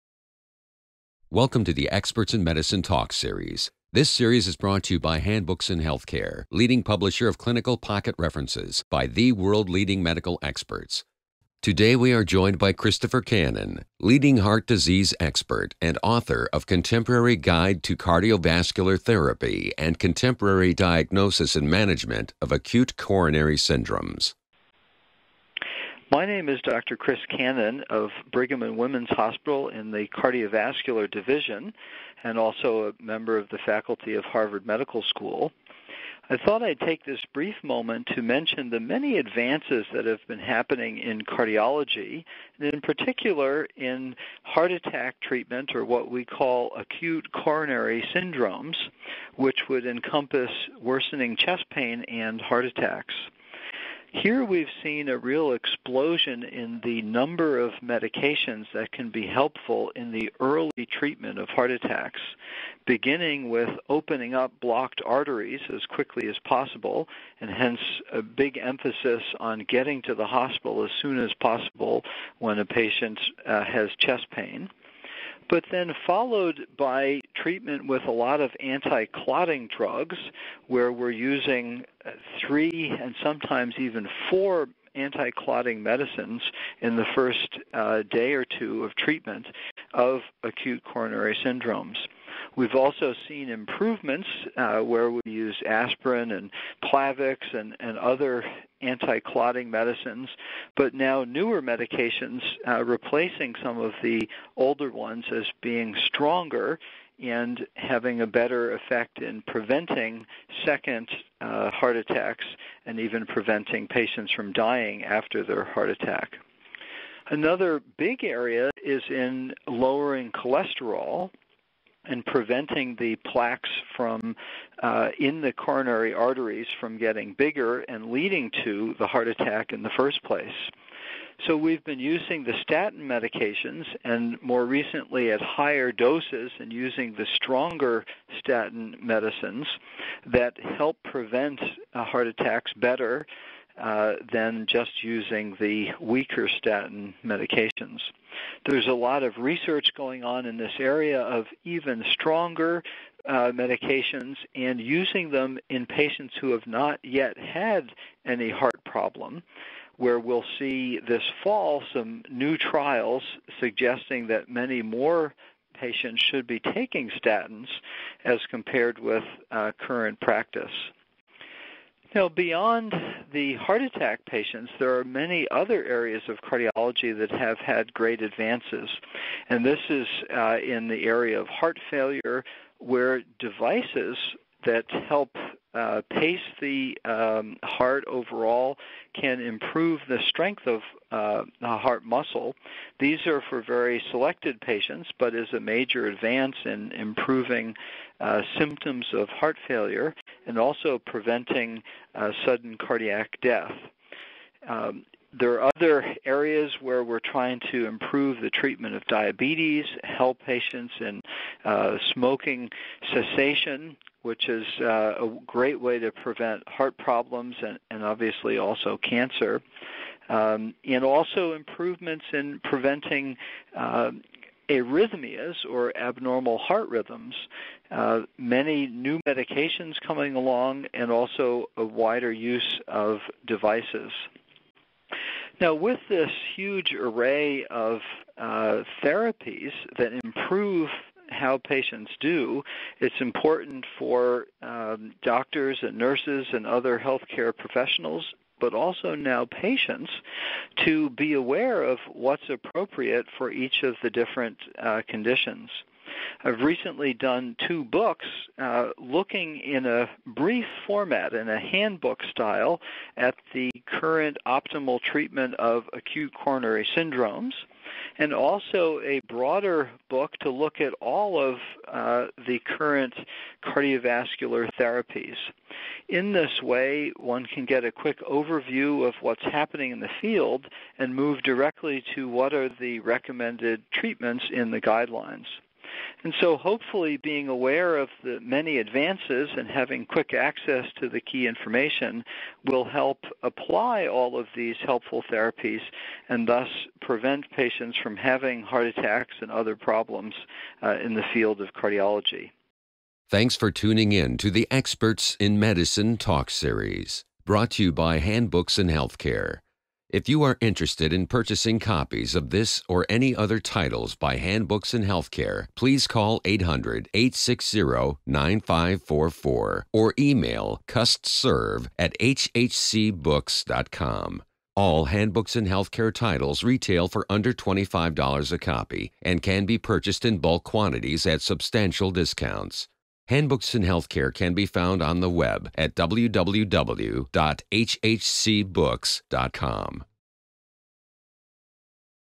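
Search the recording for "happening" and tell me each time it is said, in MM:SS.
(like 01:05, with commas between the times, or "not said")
00:40, 04:39.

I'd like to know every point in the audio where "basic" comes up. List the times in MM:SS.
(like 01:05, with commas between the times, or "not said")
not said.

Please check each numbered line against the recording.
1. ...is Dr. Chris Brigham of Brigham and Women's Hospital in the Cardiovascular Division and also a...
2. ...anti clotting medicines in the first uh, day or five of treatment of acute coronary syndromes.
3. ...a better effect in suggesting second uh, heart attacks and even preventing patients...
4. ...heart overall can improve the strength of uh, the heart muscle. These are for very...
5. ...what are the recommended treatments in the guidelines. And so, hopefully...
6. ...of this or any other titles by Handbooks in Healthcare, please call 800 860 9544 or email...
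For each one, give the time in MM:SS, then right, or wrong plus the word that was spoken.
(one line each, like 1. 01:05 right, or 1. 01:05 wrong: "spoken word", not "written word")
1. 00:26 wrong: "Cannon", not "Brigham"
2. 01:24 wrong: "two", not "five"
3. 01:48 wrong: "preventing", not "suggesting"
4. 03:07 right
5. 04:42 right
6. 05:12 right.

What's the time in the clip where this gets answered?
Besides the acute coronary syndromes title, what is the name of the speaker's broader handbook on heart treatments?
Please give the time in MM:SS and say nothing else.
00:16.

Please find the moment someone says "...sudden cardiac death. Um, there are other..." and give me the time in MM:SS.
03:22.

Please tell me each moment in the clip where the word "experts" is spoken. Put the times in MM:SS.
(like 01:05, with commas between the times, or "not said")
00:01, 00:10, 00:15, 05:04.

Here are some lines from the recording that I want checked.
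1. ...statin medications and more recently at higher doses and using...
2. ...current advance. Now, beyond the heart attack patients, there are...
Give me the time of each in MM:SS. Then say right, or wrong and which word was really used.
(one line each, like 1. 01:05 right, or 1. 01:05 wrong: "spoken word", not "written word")
1. 02:12 right
2. 02:49 wrong: "practice", not "advance".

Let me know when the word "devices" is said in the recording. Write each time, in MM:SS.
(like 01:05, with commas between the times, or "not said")
03:03, 03:53.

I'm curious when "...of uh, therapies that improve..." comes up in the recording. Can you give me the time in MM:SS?
03:57.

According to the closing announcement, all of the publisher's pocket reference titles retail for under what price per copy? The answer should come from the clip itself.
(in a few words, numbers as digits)
$25.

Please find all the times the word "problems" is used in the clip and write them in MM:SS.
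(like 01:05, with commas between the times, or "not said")
02:38, 03:36, 04:59.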